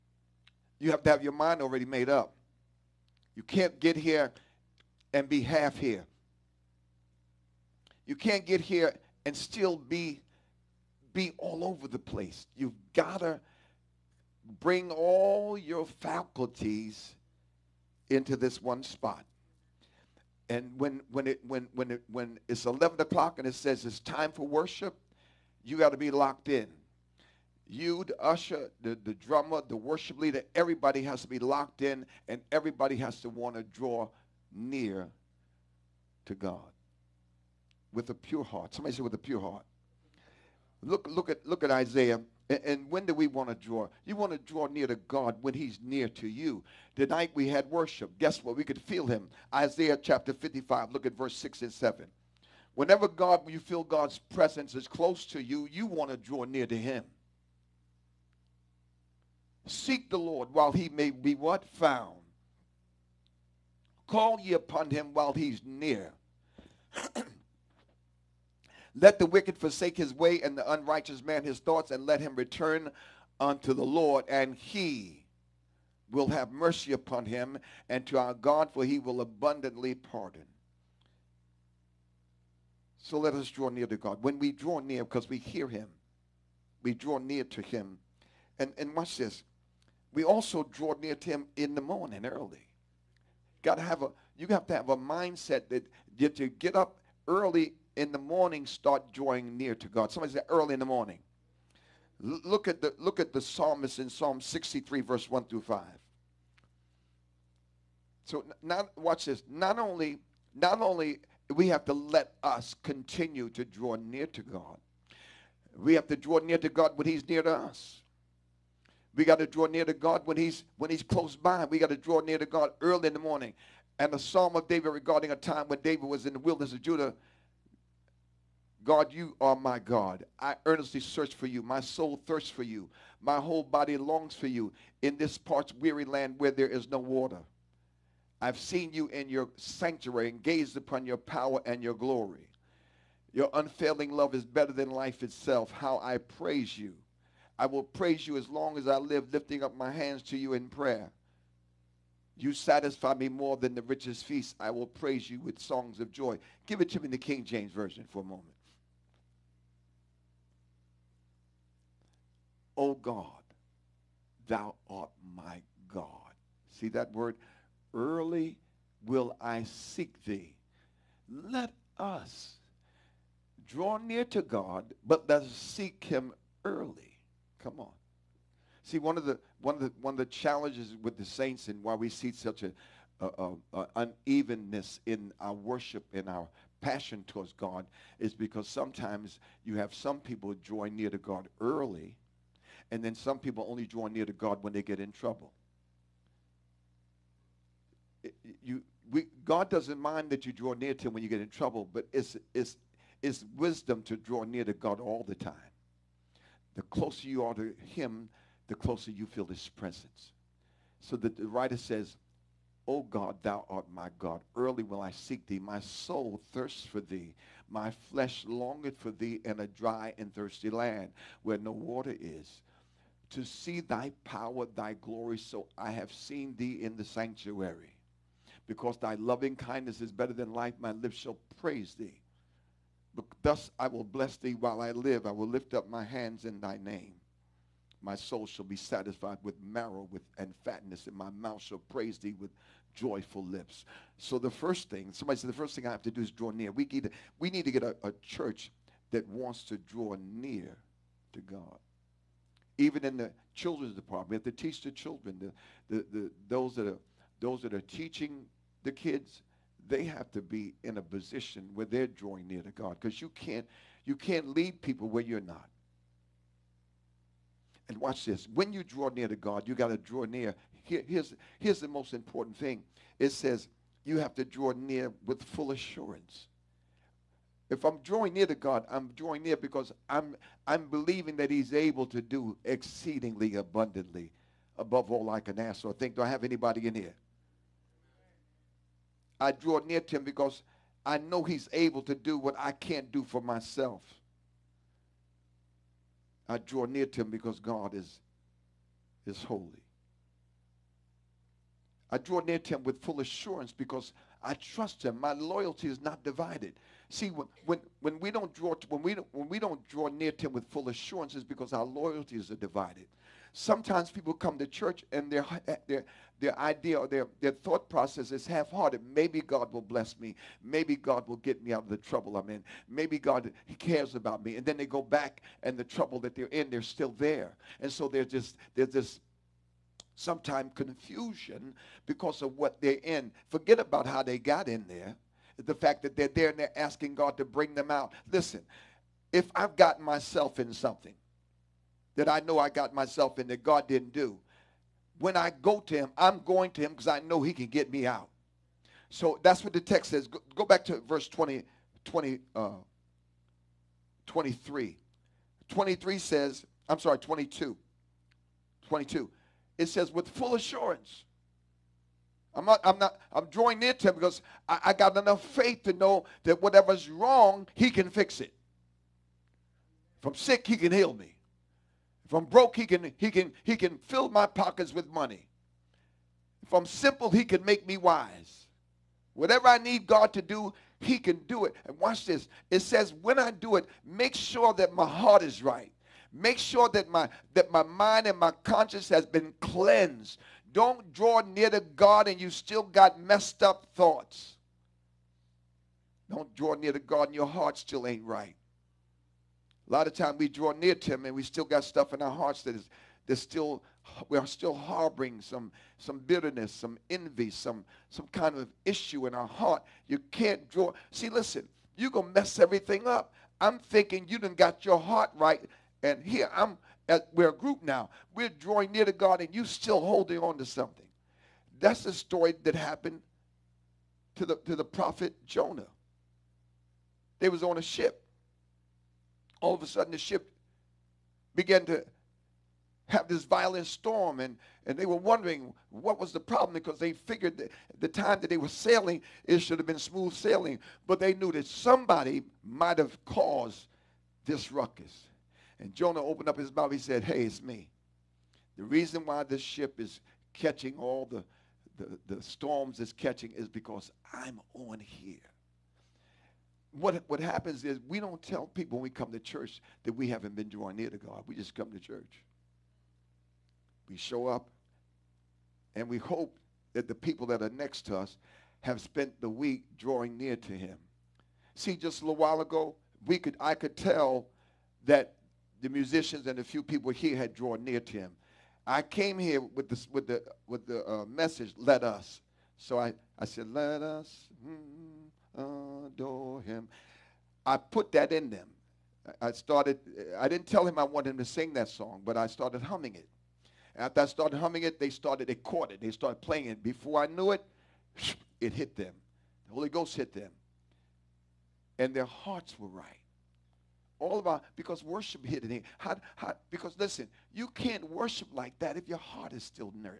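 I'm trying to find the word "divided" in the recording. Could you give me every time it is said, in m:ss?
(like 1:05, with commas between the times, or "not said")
5:06, 5:12.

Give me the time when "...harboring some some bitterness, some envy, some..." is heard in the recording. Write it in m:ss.
6:44.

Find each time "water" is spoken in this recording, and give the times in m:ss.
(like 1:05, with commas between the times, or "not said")
2:16, 3:41.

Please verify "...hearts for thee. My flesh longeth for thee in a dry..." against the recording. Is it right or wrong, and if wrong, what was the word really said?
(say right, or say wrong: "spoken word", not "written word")
wrong: "thirsts", not "hearts".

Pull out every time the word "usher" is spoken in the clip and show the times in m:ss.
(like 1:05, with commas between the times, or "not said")
0:28.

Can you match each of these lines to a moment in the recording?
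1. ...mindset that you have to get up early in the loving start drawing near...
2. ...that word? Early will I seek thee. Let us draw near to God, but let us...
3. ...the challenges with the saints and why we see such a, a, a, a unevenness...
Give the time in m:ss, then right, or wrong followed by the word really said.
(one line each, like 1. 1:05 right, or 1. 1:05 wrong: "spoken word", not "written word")
1. 1:34 wrong: "morning", not "loving"
2. 2:46 right
3. 3:00 right.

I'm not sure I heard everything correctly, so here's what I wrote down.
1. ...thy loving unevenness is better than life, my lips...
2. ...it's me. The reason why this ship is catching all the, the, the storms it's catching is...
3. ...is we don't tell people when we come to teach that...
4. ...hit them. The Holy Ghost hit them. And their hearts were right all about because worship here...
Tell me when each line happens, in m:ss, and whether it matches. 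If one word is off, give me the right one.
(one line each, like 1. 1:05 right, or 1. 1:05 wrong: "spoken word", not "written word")
1. 3:48 wrong: "kindness", not "unevenness"
2. 7:27 right
3. 7:37 wrong: "church", not "teach"
4. 8:18 right.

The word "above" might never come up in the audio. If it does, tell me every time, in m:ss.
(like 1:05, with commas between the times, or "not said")
4:44.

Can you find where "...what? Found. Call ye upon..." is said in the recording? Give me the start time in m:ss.
1:01.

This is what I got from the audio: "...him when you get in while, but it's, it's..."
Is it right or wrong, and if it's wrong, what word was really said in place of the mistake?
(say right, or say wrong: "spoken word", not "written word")
wrong: "trouble", not "while".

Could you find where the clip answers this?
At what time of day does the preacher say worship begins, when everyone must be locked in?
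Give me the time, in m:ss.
0:22.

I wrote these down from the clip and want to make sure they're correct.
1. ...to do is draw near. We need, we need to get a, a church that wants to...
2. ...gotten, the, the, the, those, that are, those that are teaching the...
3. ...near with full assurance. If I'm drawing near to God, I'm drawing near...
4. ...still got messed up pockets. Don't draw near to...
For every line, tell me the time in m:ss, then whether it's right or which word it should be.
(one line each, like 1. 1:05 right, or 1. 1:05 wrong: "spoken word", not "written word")
1. 4:06 right
2. 4:14 wrong: "children", not "gotten"
3. 4:34 right
4. 6:32 wrong: "thoughts", not "pockets".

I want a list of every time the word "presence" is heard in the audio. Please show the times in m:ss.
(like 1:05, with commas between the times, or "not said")
0:54, 3:29.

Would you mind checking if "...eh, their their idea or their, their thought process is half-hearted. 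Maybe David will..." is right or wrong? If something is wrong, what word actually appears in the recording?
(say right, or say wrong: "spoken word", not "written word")
wrong: "God", not "David".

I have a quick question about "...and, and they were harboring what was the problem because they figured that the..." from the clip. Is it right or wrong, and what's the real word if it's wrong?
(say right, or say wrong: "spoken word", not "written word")
wrong: "wondering", not "harboring".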